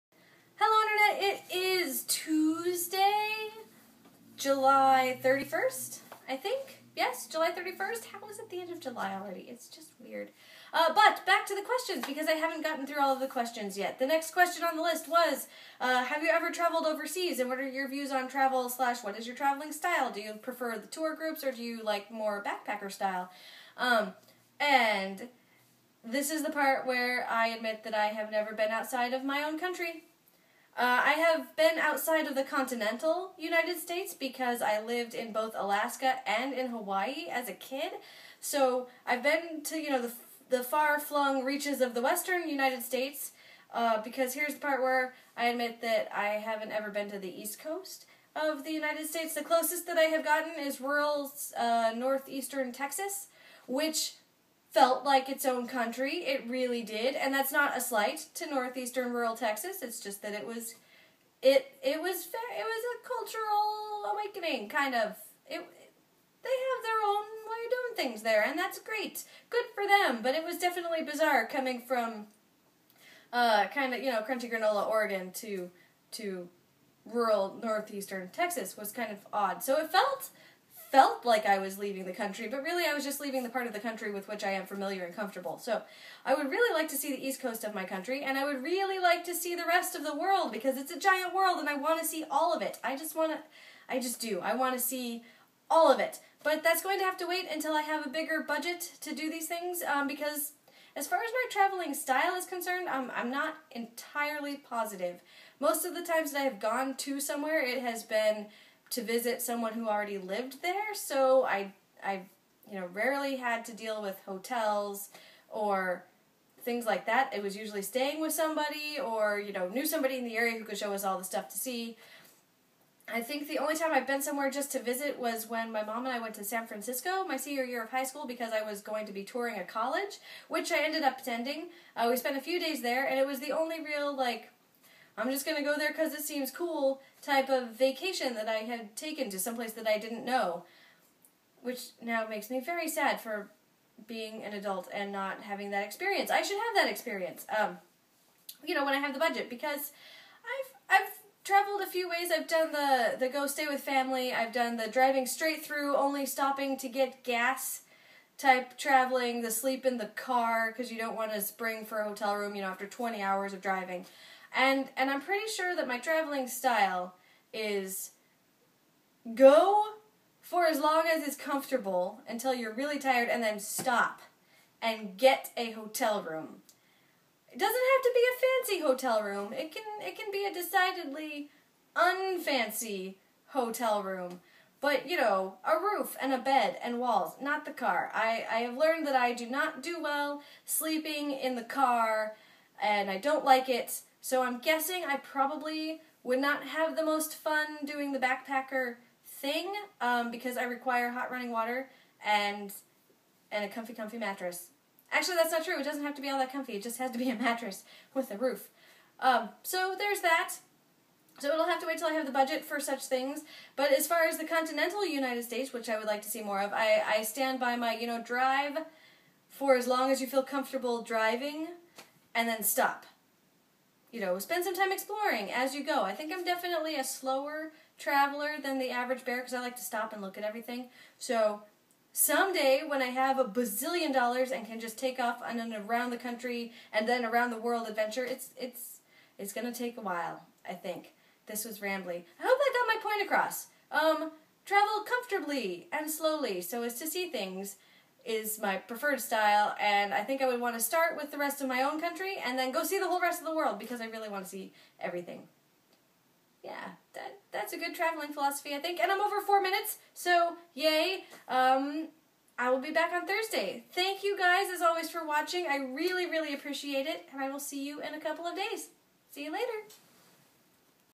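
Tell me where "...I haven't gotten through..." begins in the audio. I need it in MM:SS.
00:12.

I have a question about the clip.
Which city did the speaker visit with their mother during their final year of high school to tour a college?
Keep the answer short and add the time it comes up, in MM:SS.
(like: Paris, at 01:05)
San Francisco, at 02:06.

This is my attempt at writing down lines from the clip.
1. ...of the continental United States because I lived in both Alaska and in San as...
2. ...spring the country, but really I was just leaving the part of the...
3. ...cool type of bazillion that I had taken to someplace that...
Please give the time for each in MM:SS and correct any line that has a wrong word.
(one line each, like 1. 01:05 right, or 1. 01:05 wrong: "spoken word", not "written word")
1. 00:32 wrong: "Hawaii", not "San"
2. 01:21 wrong: "leaving", not "spring"
3. 02:16 wrong: "vacation", not "bazillion".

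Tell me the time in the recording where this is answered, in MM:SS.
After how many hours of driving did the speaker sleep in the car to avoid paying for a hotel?
02:42.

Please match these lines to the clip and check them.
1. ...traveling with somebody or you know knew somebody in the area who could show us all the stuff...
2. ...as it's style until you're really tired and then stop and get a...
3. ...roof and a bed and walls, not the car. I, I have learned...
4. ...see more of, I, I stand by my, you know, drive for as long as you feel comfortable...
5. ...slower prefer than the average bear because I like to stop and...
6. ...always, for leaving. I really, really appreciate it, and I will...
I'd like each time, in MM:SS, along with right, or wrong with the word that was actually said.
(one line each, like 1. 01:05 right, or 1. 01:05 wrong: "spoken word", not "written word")
1. 01:57 wrong: "staying", not "traveling"
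2. 02:51 wrong: "comfortable", not "style"
3. 03:05 right
4. 03:36 right
5. 03:47 wrong: "traveler", not "prefer"
6. 04:24 wrong: "watching", not "leaving".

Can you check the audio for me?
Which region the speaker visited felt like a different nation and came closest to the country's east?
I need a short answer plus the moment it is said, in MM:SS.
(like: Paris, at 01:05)
rural northeastern Texas, at 00:50.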